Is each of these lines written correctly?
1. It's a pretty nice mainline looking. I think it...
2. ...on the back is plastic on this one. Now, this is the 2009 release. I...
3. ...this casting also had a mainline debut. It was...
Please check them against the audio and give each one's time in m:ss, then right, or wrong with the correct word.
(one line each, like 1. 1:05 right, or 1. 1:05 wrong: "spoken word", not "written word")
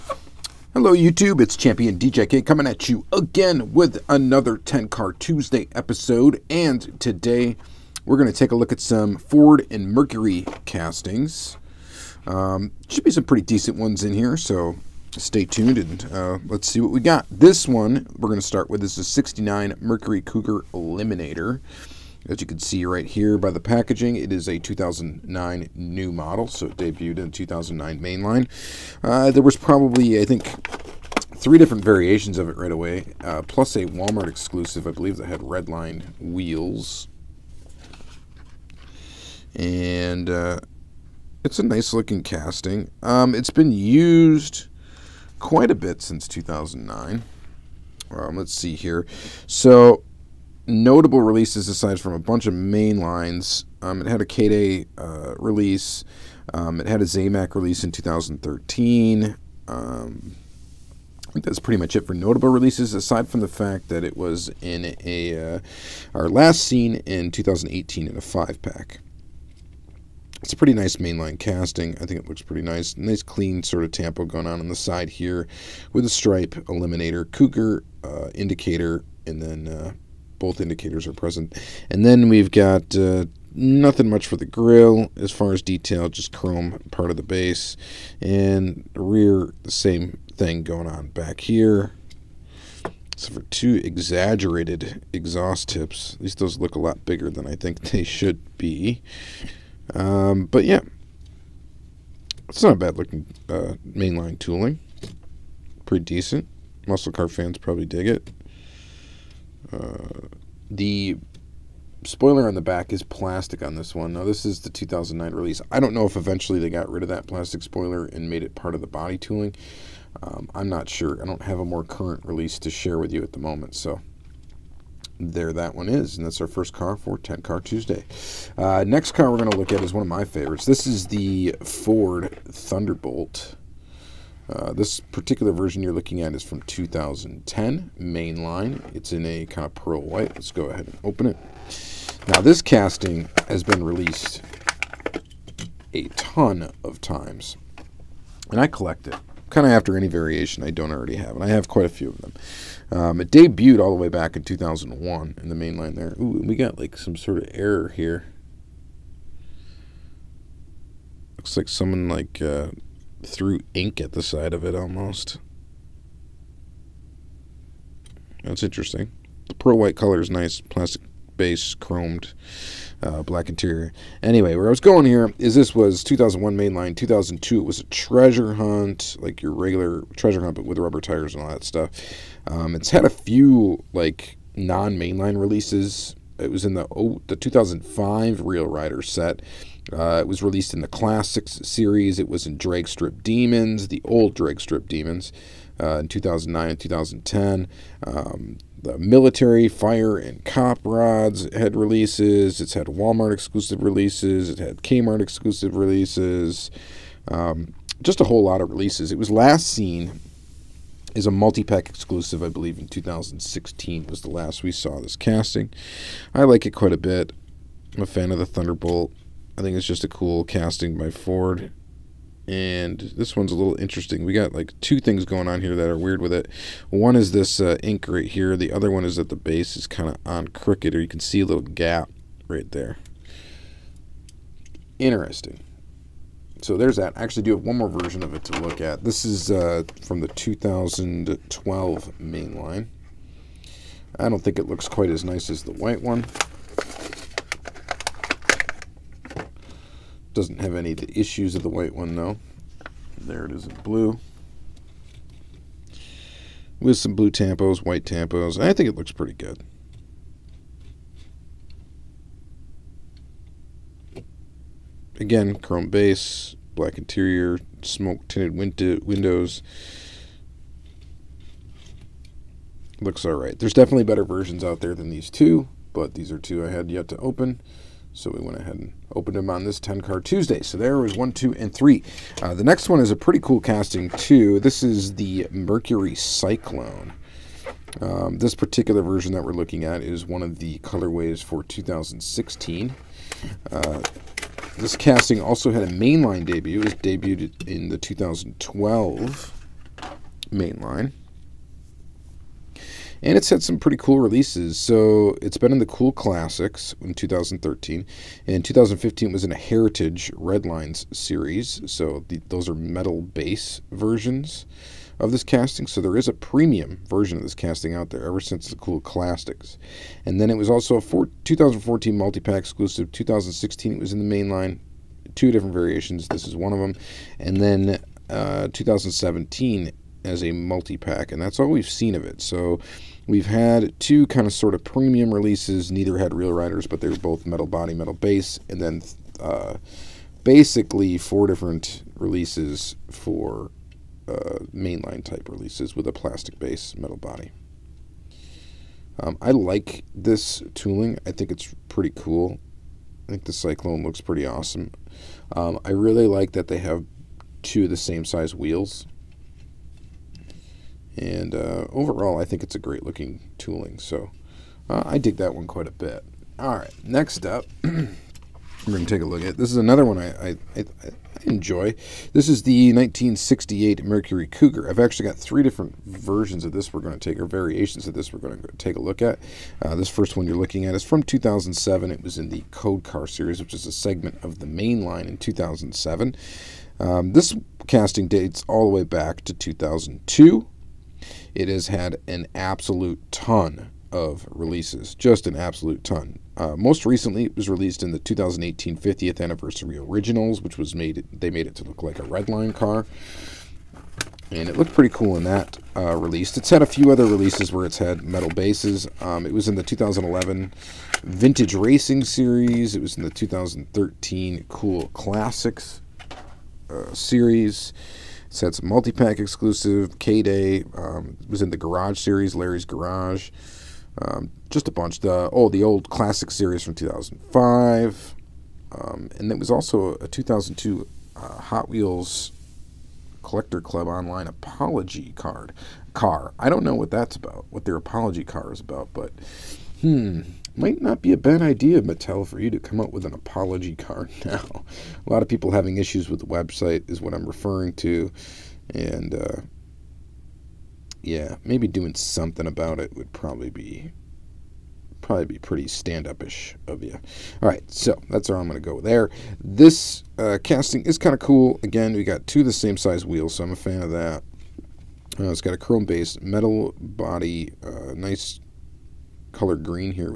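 1. 1:10 wrong: "casting", not "looking"
2. 1:52 right
3. 4:54 right.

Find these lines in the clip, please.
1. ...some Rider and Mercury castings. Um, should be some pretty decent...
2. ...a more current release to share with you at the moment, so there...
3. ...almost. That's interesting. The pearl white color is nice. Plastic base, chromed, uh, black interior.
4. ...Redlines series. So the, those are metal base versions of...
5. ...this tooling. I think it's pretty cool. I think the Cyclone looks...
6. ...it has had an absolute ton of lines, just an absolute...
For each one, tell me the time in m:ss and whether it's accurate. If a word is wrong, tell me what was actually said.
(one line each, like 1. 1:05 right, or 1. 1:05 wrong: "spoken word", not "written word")
1. 0:08 wrong: "Ford", not "Rider"
2. 2:01 right
3. 2:44 right
4. 5:10 right
5. 5:50 right
6. 6:31 wrong: "releases", not "lines".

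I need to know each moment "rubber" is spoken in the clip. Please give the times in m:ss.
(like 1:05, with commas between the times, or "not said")
3:00.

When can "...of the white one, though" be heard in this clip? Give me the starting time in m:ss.
4:11.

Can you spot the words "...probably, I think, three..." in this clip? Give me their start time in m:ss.
0:29.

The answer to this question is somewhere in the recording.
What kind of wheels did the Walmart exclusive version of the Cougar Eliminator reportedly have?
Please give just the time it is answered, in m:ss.
0:35.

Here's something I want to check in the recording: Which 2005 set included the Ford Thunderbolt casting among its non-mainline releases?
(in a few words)
Real Rider set.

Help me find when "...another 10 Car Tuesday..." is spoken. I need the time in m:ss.
0:04.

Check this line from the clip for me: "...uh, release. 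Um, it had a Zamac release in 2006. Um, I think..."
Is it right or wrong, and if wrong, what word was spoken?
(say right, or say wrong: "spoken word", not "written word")
wrong: "2013", not "2006".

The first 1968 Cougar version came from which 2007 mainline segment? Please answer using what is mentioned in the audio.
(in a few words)
Code Car series.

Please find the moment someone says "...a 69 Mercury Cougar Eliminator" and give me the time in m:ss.
0:19.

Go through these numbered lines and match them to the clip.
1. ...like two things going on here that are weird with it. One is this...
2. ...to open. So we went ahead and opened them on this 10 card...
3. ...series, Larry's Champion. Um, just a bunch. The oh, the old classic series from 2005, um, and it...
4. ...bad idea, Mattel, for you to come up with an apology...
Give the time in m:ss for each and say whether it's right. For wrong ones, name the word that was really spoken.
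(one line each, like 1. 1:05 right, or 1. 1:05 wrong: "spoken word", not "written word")
1. 3:44 right
2. 4:37 right
3. 7:02 wrong: "Garage", not "Champion"
4. 7:21 right.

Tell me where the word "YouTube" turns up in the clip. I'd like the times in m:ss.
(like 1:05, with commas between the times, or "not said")
0:00.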